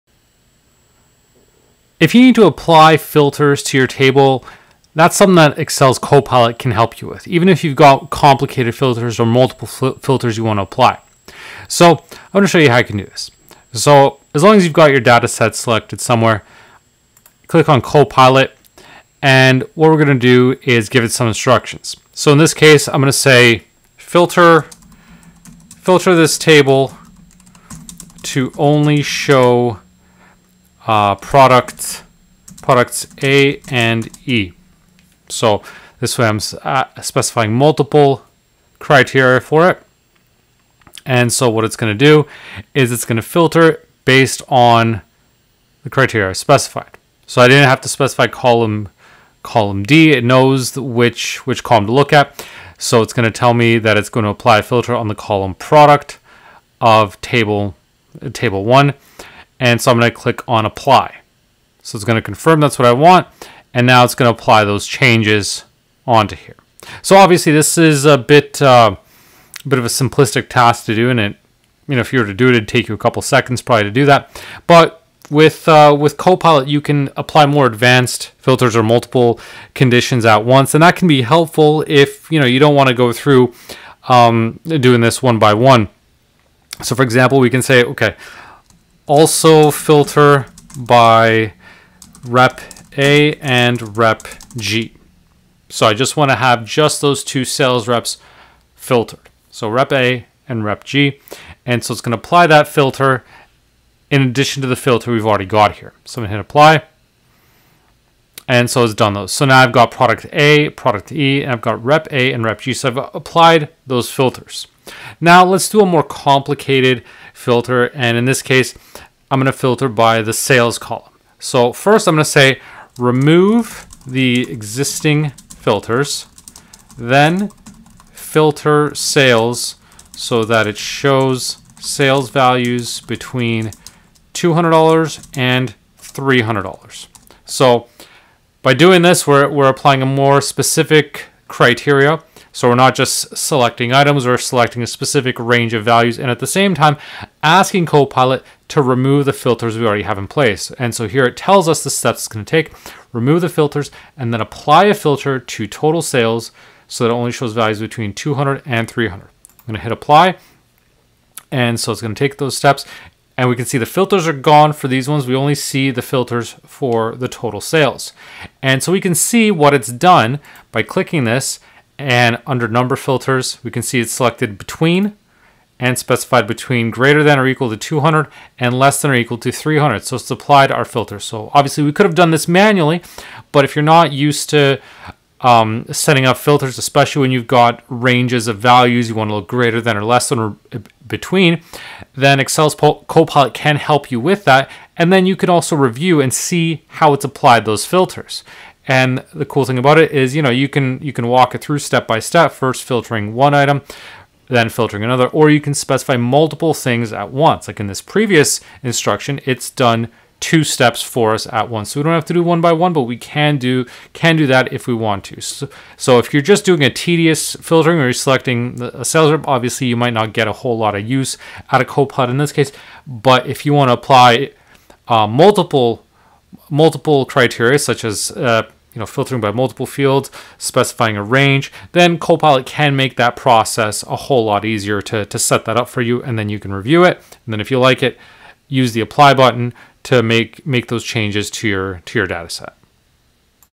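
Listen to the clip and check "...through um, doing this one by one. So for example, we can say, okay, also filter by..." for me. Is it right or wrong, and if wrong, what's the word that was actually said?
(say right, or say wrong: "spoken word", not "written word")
right.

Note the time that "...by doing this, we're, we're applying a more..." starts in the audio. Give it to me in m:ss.
2:18.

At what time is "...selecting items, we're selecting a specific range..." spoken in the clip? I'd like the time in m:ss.
2:23.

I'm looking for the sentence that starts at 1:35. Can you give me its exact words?
So I just want to have just those two sales reps filtered.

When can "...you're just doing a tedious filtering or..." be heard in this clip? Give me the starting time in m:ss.
3:36.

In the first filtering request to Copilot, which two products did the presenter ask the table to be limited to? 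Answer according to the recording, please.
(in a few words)
Products A and E.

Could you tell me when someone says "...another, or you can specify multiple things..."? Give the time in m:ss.
3:25.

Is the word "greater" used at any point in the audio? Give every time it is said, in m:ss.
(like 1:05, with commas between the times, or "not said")
2:56, 3:09.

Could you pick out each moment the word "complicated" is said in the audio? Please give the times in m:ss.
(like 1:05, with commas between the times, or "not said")
0:08, 1:56.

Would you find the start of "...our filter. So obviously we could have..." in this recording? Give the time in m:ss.
3:00.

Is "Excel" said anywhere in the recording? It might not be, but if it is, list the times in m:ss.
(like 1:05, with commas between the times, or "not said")
0:05, 3:12.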